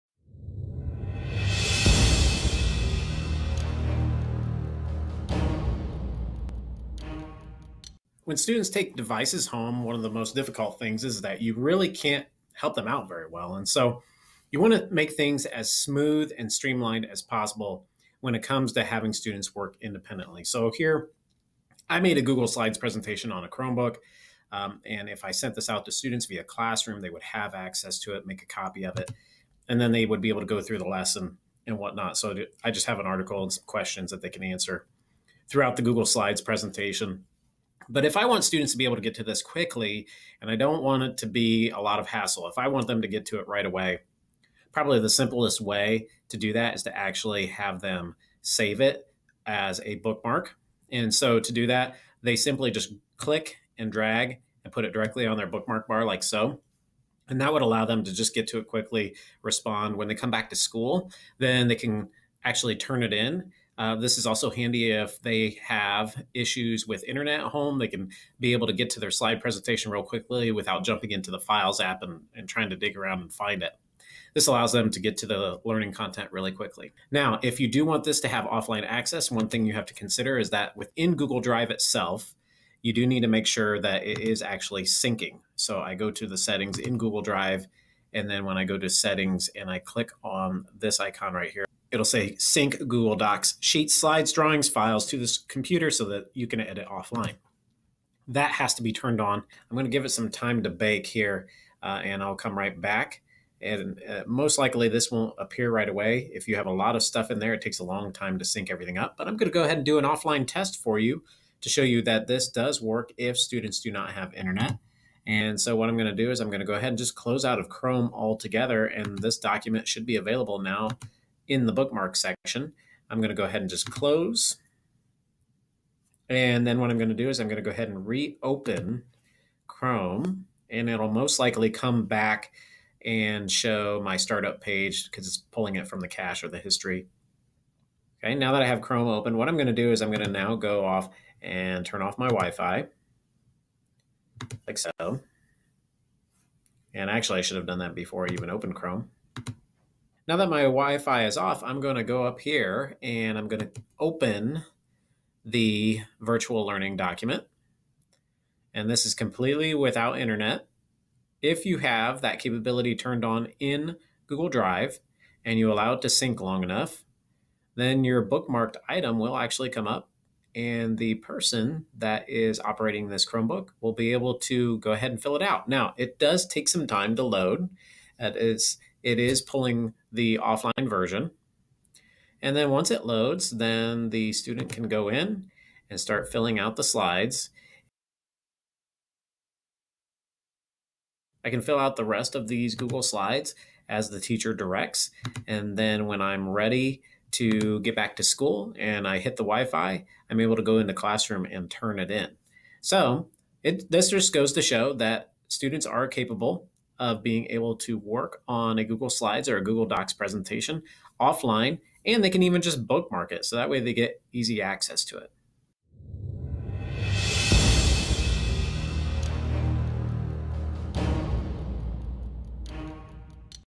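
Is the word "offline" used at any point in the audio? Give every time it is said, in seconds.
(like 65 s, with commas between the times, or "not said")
78 s, 96 s, 110 s, 180 s, 211 s.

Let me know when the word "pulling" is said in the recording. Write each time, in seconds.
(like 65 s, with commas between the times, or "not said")
135 s, 179 s.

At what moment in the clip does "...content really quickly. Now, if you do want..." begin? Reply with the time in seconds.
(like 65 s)
75 s.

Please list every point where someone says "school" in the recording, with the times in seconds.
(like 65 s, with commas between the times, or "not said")
60 s, 198 s.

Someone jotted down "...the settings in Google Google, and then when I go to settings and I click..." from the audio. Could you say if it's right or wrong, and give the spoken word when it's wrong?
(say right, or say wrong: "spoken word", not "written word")
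wrong: "Drive", not "Google".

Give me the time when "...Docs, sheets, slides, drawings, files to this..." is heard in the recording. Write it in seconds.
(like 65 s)
93 s.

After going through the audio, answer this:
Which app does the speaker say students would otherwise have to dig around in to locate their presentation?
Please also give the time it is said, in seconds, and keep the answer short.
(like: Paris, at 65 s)
Files app, at 71 s.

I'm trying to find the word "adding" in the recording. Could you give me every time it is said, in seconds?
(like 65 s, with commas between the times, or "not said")
not said.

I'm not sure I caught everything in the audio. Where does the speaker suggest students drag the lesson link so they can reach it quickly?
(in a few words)
bookmark bar.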